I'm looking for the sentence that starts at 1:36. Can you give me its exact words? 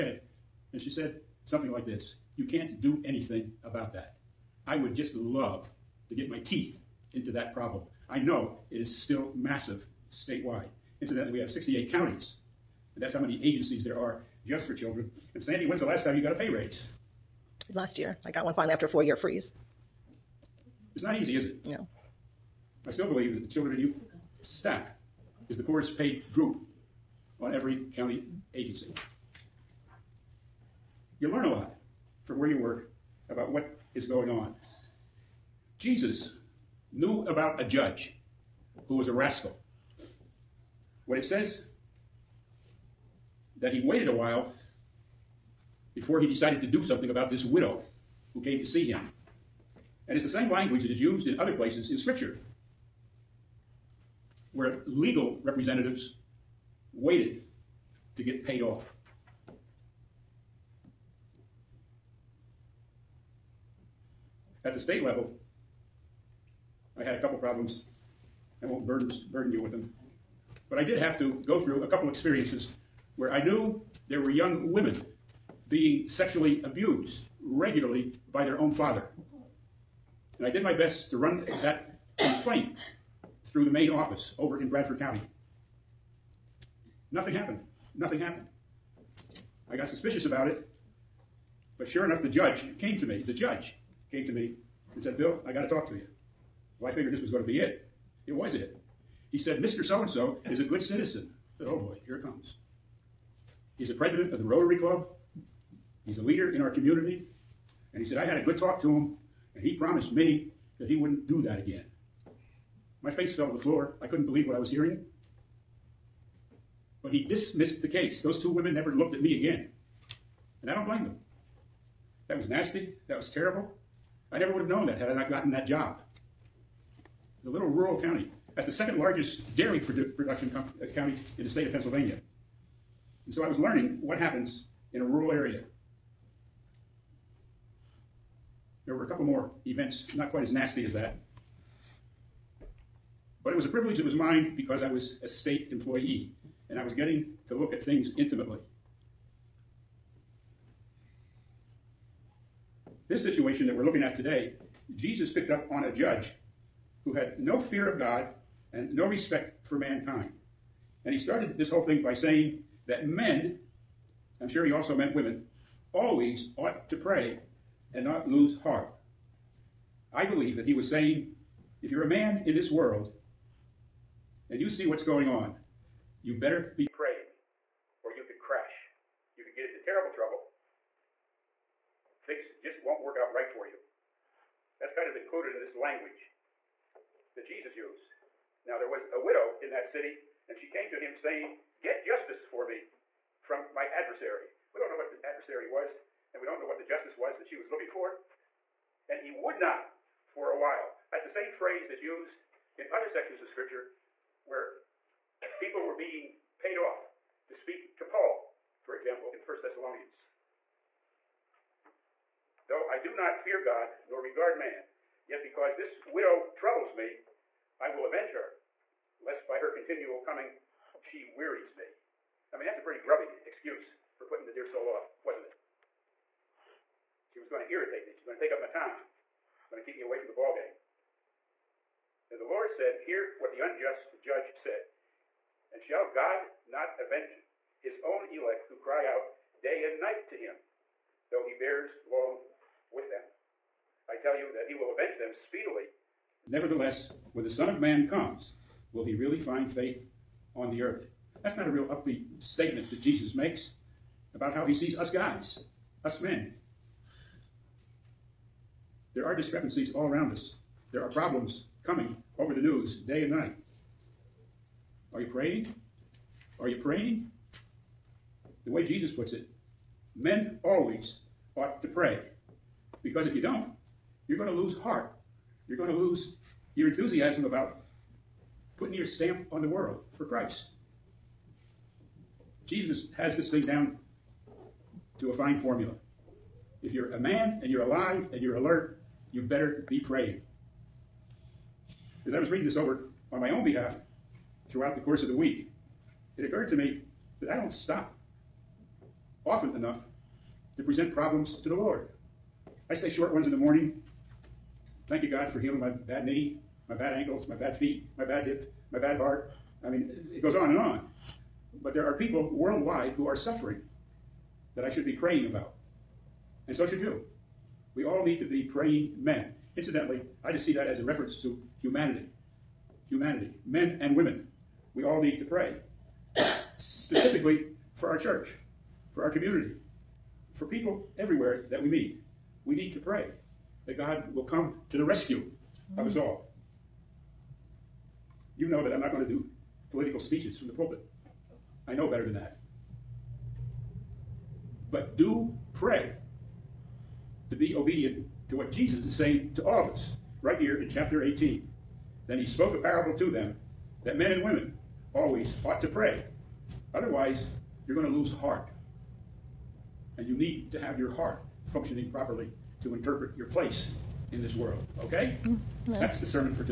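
Well, I figured this was going to be it.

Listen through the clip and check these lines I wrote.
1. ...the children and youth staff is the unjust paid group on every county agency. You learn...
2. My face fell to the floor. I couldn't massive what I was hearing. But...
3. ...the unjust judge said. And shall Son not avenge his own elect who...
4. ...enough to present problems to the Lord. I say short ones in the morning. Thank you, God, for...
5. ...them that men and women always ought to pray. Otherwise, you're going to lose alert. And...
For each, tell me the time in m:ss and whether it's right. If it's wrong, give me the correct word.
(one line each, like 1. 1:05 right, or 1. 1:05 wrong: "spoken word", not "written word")
1. 0:23 wrong: "poorest", not "unjust"
2. 1:53 wrong: "believe", not "massive"
3. 3:53 wrong: "God", not "Son"
4. 4:59 right
5. 5:53 wrong: "heart", not "alert".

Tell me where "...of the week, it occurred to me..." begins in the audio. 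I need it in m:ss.
4:55.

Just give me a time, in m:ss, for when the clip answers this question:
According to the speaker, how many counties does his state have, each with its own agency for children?
0:11.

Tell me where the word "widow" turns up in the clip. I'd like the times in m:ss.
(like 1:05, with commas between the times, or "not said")
0:47, 3:09, 3:36.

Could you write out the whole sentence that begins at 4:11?
That's not a real upbeat statement that Jesus makes about how he sees us guys, us men.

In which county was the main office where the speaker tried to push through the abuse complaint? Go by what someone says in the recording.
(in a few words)
Bradford County.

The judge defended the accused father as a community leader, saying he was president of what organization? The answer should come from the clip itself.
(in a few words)
Rotary Club.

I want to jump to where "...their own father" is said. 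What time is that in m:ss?
1:18.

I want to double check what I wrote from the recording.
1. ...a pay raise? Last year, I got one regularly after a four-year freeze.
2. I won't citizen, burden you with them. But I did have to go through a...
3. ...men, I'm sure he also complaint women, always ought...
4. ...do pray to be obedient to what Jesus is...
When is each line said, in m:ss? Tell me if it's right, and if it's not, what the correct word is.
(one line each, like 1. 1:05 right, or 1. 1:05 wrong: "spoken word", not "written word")
1. 0:16 wrong: "finally", not "regularly"
2. 1:08 wrong: "burden", not "citizen"
3. 2:43 wrong: "meant", not "complaint"
4. 5:45 right.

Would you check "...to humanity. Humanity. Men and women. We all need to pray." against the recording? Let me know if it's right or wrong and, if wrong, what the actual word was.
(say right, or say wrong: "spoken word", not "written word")
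right.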